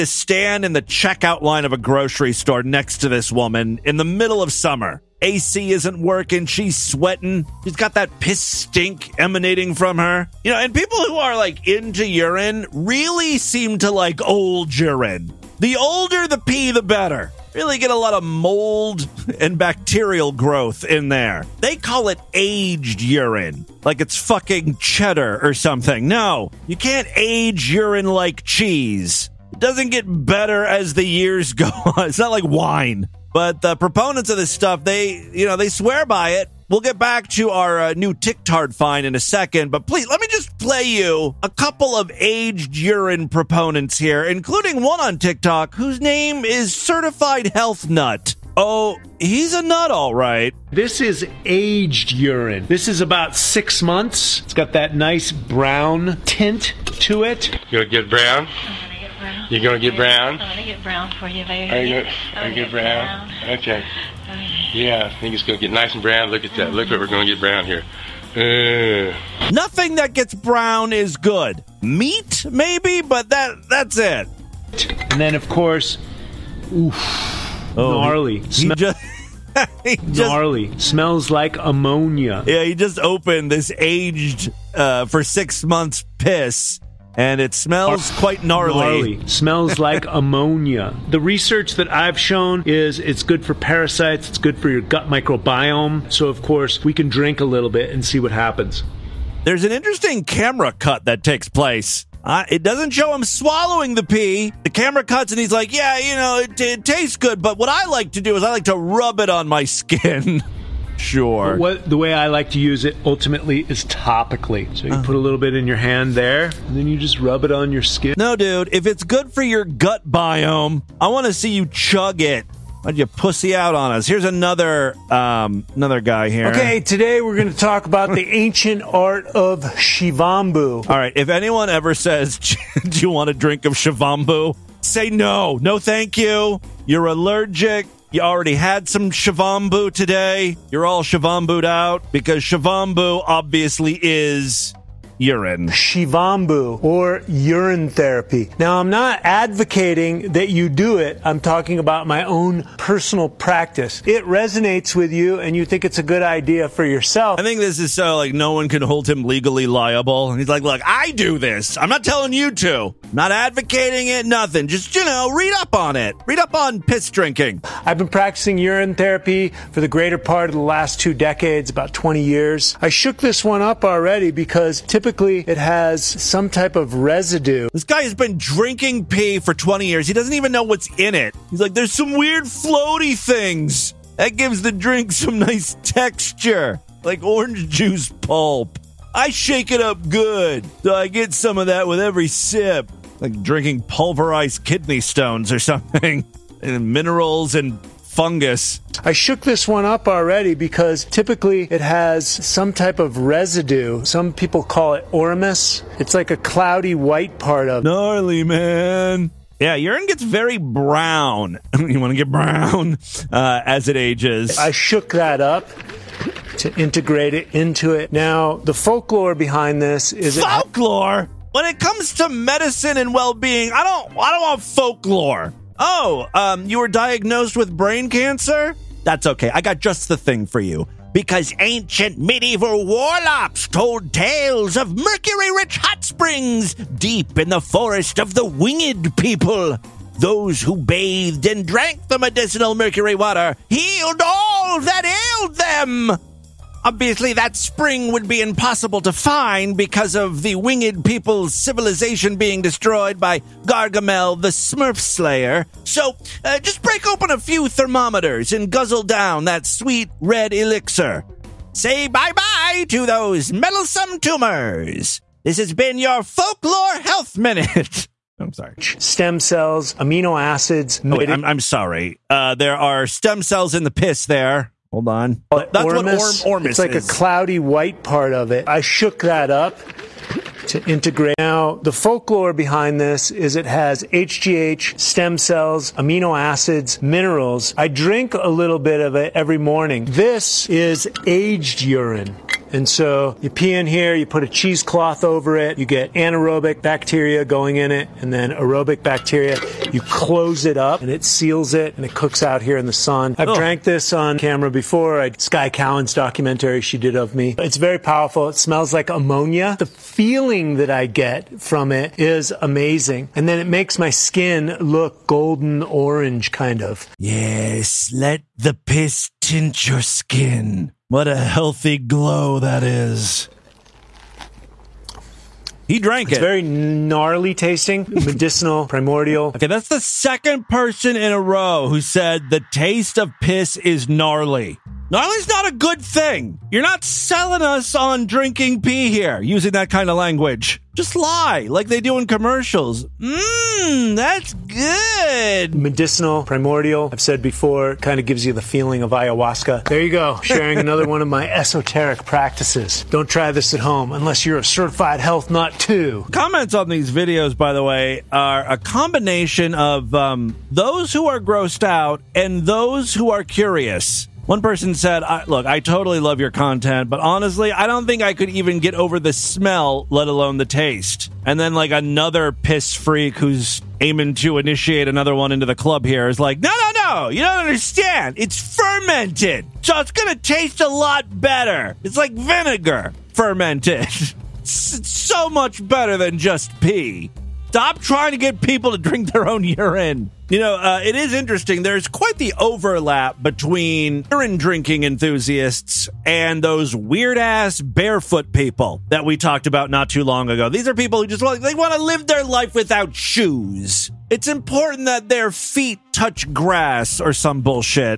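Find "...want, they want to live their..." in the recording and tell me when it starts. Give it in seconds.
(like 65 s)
401 s.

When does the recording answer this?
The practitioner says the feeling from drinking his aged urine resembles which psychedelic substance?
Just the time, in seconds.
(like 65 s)
349 s.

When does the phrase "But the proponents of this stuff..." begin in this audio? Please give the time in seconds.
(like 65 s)
33 s.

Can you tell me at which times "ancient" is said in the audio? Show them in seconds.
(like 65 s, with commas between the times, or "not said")
128 s, 231 s.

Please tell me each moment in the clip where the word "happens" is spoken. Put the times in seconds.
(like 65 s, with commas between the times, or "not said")
98 s.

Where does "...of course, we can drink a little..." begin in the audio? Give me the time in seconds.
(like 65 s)
96 s.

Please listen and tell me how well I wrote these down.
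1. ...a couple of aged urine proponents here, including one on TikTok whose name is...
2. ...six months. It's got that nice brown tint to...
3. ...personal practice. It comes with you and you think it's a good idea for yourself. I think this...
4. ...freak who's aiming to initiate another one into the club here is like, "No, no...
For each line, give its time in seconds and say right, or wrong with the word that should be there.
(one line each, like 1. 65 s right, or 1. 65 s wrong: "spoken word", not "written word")
1. 41 s right
2. 53 s right
3. 152 s wrong: "resonates", not "comes"
4. 372 s right.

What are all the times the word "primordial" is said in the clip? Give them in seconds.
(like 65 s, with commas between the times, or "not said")
328 s, 346 s.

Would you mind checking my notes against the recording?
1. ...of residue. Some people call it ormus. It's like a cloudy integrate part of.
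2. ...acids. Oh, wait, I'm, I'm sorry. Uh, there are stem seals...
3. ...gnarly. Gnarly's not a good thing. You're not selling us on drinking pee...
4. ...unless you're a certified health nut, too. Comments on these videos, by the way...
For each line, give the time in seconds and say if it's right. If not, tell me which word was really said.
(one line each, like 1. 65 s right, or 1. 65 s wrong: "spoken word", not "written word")
1. 202 s wrong: "white", not "integrate"
2. 270 s wrong: "cells", not "seals"
3. 334 s right
4. 354 s right.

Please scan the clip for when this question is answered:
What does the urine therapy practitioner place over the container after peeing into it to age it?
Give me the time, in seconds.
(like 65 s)
294 s.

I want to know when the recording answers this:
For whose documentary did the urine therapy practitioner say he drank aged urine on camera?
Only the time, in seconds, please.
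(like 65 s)
305 s.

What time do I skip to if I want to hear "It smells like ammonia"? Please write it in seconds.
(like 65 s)
308 s.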